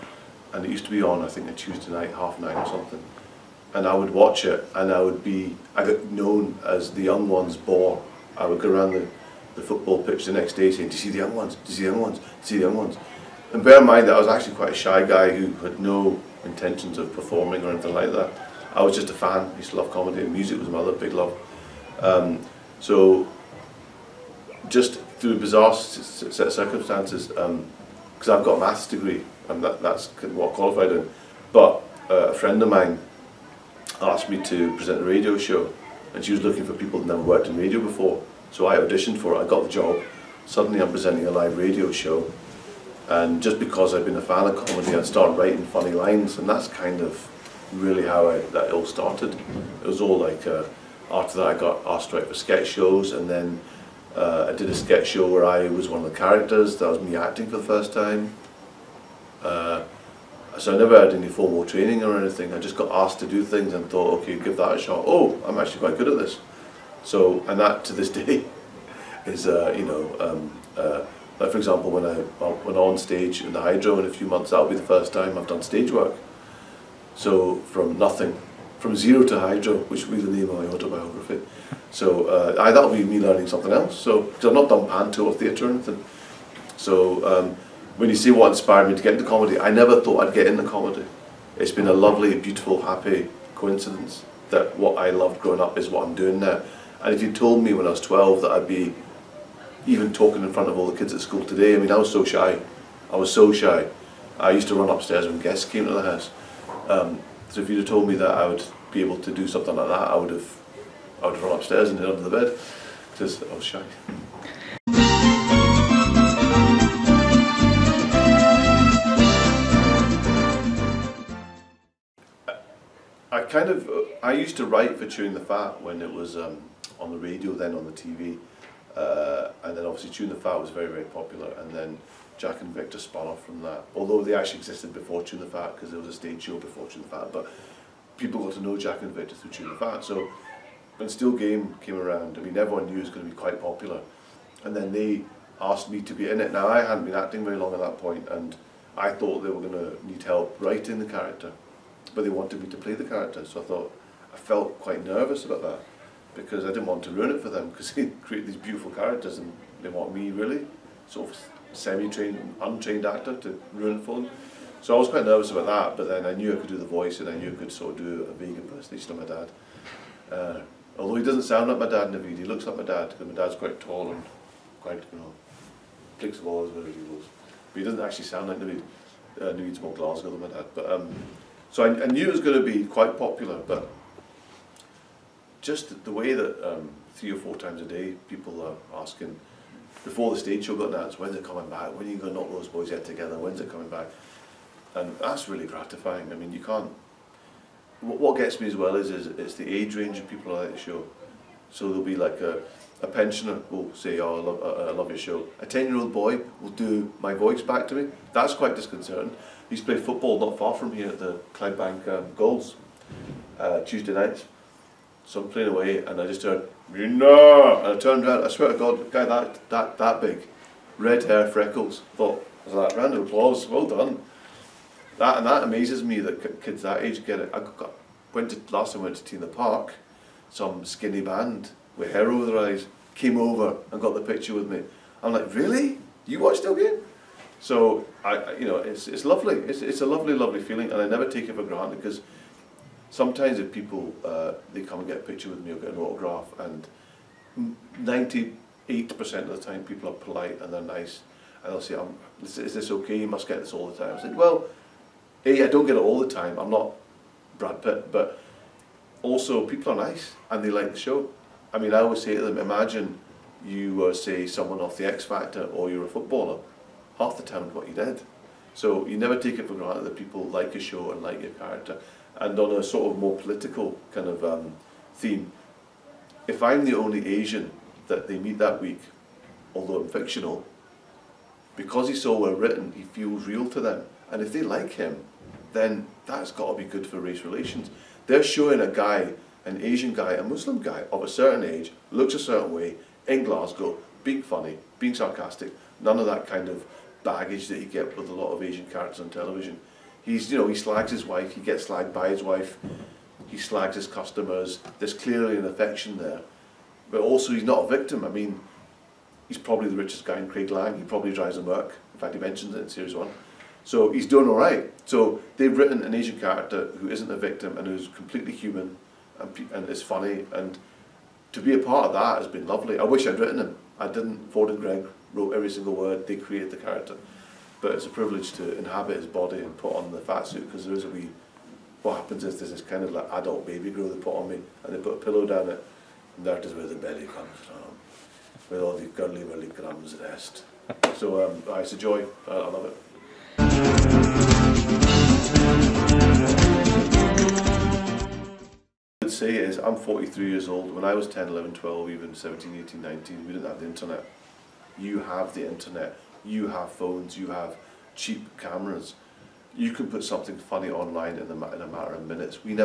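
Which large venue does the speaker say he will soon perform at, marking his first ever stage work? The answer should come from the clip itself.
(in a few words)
The Hydro.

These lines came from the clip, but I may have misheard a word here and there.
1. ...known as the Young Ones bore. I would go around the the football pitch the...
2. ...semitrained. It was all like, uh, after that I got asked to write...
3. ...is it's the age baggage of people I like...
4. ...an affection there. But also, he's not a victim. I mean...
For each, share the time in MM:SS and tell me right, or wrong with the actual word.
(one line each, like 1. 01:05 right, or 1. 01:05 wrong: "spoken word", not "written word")
1. 00:06 right
2. 00:48 wrong: "started", not "semitrained"
3. 03:19 wrong: "range", not "baggage"
4. 05:05 right.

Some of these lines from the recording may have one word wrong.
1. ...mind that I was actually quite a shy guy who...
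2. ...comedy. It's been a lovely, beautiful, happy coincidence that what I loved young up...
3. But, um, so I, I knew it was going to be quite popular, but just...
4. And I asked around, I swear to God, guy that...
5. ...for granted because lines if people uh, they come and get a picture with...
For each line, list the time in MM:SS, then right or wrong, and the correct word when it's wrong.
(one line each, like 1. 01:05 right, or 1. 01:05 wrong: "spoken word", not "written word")
1. 00:13 right
2. 01:30 wrong: "growing", not "young"
3. 03:00 right
4. 03:37 wrong: "turned", not "asked"
5. 04:01 wrong: "sometimes", not "lines".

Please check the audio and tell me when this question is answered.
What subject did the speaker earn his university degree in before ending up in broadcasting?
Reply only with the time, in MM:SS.
00:28.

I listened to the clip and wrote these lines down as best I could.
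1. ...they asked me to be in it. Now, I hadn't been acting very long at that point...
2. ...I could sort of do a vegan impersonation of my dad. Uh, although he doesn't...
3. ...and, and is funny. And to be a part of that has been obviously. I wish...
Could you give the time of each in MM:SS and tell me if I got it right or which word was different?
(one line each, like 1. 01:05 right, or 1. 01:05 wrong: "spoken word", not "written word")
1. 02:24 right
2. 02:47 right
3. 05:19 wrong: "lovely", not "obviously".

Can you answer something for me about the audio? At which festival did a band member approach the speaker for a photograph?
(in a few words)
T in the Park.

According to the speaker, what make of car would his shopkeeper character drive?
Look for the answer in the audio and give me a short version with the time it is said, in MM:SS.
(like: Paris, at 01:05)
Merc, at 05:11.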